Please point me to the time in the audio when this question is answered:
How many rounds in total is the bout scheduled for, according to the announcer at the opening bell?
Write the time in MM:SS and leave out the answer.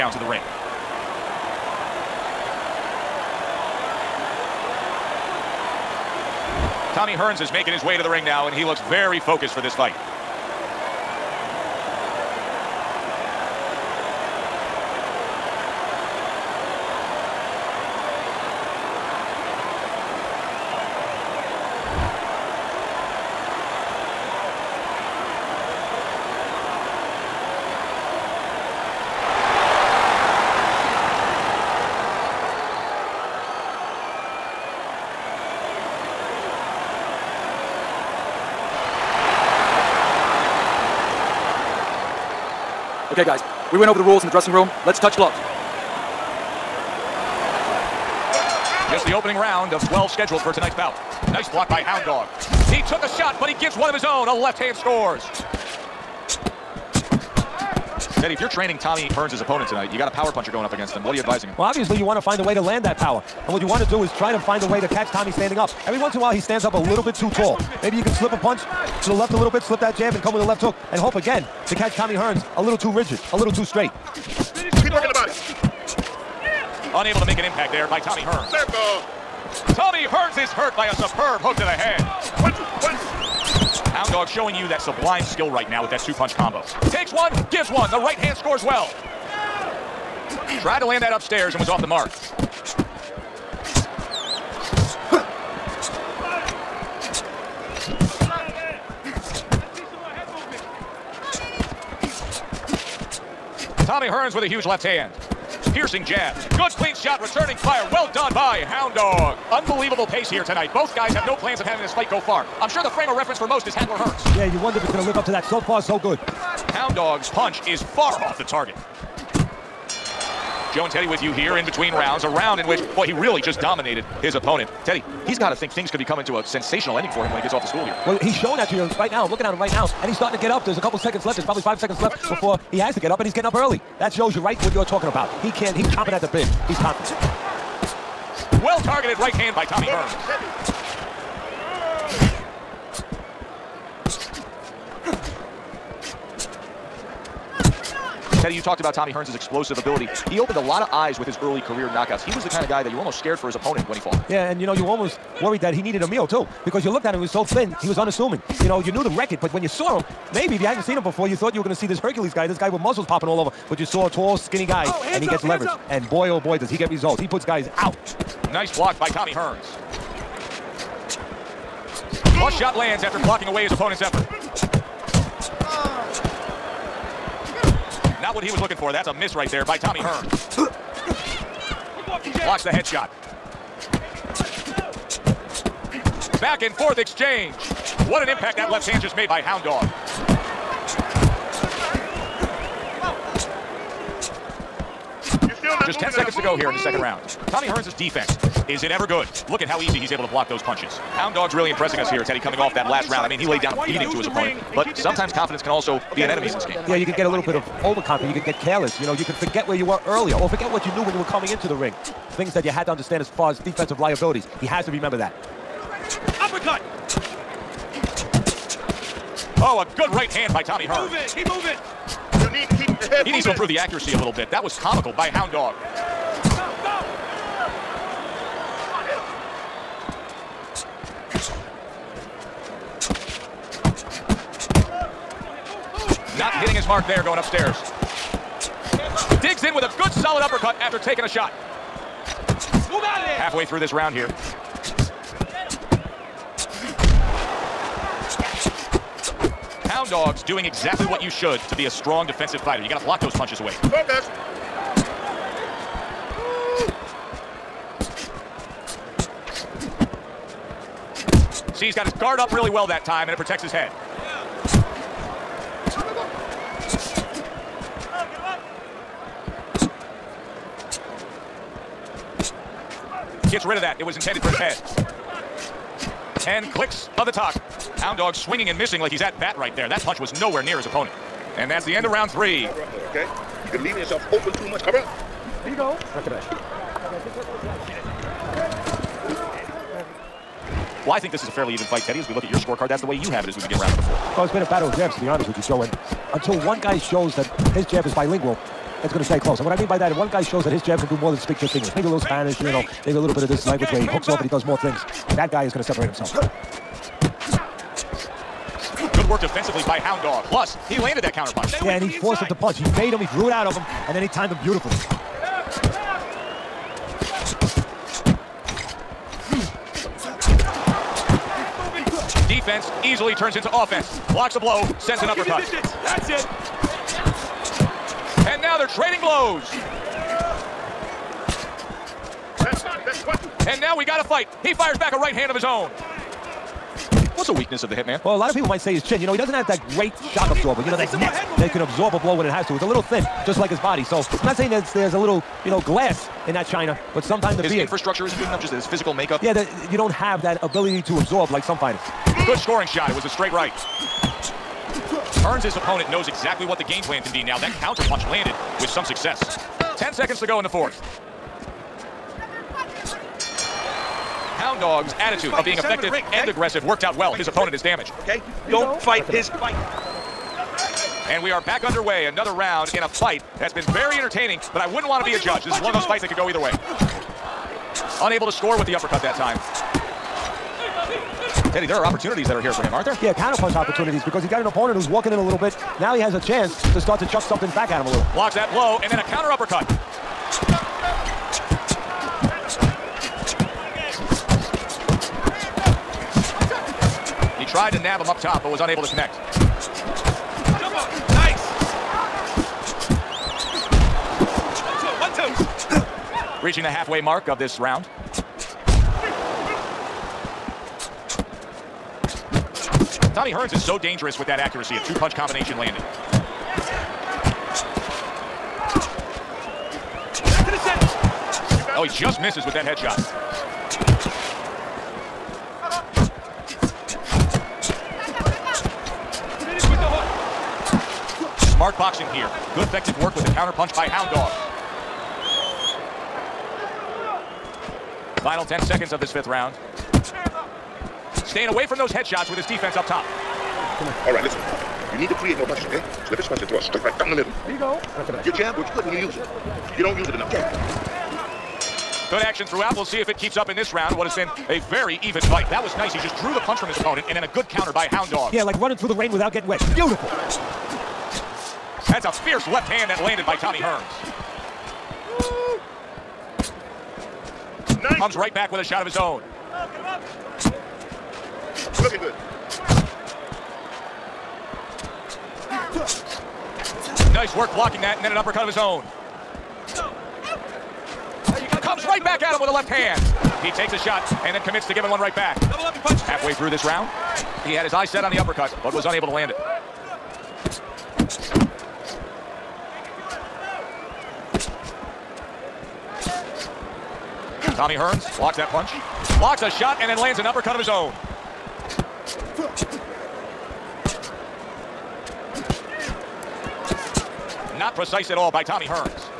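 00:49.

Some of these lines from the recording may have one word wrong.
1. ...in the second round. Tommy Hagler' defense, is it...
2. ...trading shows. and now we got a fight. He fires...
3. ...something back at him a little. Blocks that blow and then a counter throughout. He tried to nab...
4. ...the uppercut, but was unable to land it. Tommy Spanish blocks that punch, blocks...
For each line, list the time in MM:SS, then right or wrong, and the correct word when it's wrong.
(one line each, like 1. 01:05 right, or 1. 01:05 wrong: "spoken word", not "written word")
1. 03:16 wrong: "Hearns", not "Hagler"
2. 05:28 wrong: "blows", not "shows"
3. 06:27 wrong: "uppercut", not "throughout"
4. 08:08 wrong: "Hearns", not "Spanish".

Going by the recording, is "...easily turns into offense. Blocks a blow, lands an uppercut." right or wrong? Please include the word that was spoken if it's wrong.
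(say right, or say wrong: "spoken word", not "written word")
wrong: "sends", not "lands".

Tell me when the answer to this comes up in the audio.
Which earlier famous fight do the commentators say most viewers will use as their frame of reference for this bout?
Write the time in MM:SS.
01:53.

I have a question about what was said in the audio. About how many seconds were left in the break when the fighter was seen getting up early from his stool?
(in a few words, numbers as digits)
5.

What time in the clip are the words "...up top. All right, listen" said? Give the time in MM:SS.
07:22.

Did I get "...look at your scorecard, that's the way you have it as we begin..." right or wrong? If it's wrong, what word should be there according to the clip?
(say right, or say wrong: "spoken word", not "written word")
right.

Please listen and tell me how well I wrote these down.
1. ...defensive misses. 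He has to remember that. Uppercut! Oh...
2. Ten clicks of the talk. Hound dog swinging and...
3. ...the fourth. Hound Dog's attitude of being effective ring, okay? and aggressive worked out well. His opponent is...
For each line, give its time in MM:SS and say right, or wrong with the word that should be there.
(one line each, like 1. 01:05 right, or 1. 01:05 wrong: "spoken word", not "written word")
1. 03:33 wrong: "liabilities", not "misses"
2. 04:36 right
3. 06:00 right.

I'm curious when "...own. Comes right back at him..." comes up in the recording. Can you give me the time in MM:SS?
07:58.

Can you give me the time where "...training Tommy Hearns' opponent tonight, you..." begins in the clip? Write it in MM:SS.
00:58.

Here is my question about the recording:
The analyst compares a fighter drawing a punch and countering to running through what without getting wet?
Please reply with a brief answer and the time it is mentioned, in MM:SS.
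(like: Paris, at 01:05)
the rain, at 07:39.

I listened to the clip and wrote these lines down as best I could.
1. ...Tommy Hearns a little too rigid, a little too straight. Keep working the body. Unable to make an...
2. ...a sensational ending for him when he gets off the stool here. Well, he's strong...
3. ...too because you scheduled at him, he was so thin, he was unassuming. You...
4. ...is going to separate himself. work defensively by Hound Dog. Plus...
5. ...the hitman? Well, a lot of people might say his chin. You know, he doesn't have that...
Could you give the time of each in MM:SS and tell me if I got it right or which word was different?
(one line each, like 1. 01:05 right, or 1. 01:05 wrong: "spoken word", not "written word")
1. 01:11 right
2. 02:06 wrong: "showing", not "strong"
3. 02:36 wrong: "looked", not "scheduled"
4. 05:05 right
5. 05:37 right.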